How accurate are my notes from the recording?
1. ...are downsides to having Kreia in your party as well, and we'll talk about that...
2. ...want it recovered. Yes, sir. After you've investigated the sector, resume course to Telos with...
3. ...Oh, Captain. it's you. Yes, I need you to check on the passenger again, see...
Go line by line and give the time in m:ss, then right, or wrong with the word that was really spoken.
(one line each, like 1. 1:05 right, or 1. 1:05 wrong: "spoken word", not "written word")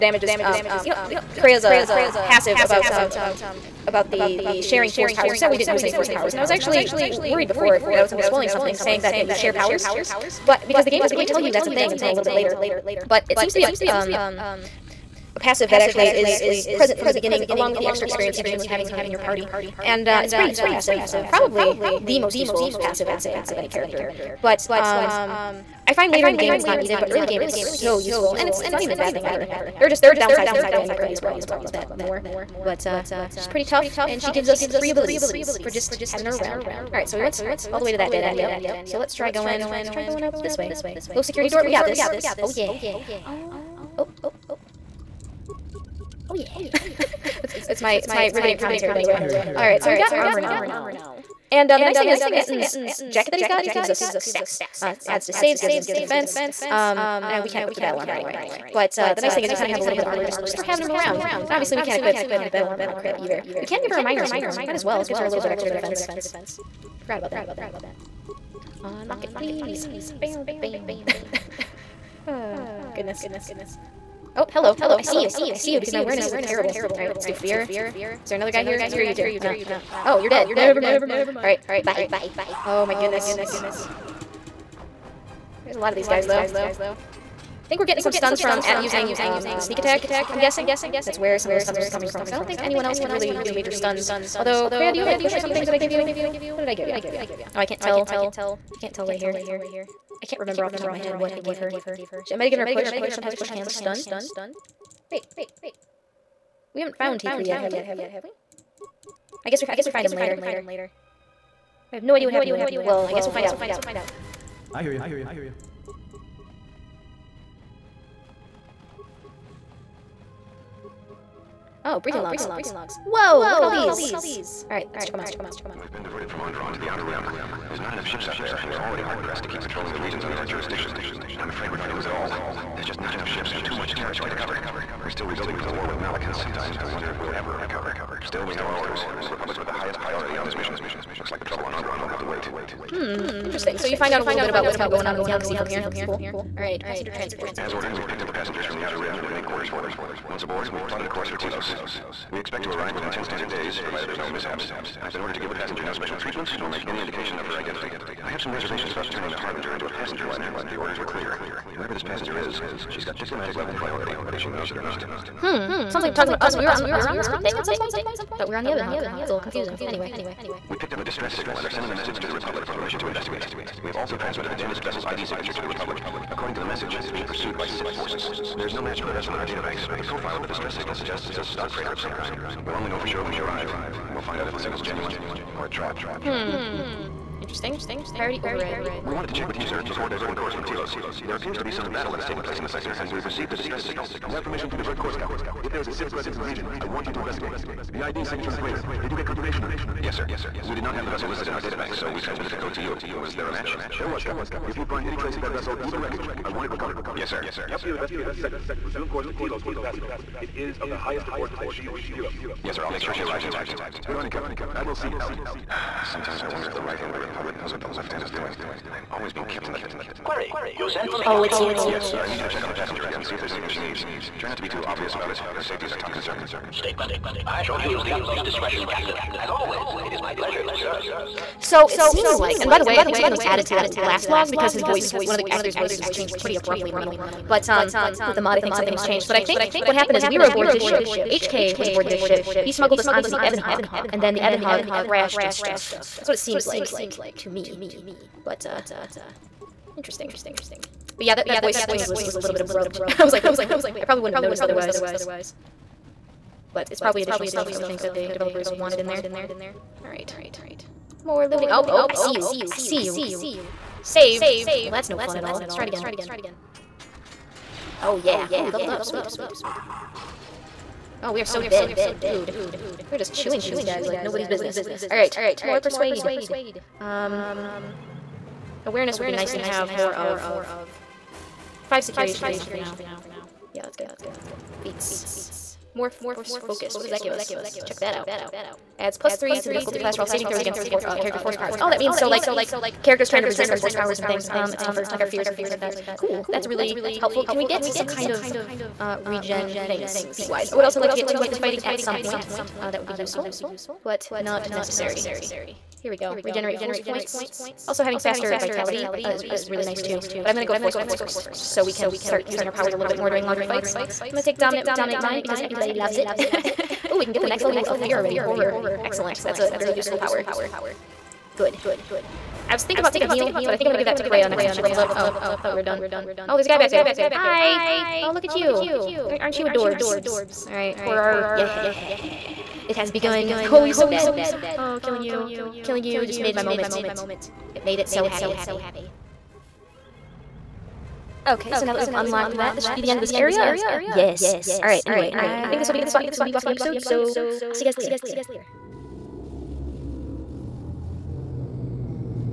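1. 0:30 right
2. 3:26 right
3. 3:41 right.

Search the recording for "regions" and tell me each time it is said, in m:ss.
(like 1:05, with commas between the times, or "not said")
2:09, 3:16.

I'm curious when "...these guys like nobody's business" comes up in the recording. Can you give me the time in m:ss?
4:33.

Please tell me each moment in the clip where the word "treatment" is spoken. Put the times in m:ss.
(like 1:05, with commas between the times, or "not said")
2:36.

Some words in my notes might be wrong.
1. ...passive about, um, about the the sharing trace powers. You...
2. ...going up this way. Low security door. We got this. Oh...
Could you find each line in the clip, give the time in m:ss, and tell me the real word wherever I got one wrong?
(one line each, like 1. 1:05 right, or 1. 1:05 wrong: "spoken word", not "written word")
1. 0:02 wrong: "force", not "trace"
2. 0:40 right.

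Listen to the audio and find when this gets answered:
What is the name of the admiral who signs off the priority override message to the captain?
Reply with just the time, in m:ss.
3:34.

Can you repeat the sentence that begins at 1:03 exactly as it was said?
We can give her a miner's uniform.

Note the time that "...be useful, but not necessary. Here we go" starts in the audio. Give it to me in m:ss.
5:03.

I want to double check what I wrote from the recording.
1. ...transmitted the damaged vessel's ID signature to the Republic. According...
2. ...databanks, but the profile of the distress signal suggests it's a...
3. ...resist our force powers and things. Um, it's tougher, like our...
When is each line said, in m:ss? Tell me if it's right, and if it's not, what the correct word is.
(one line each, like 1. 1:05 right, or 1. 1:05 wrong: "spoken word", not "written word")
1. 2:54 right
2. 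2:59 right
3. 4:53 right.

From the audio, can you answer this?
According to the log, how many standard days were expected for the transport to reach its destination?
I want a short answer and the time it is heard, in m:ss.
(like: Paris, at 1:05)
10, at 2:33.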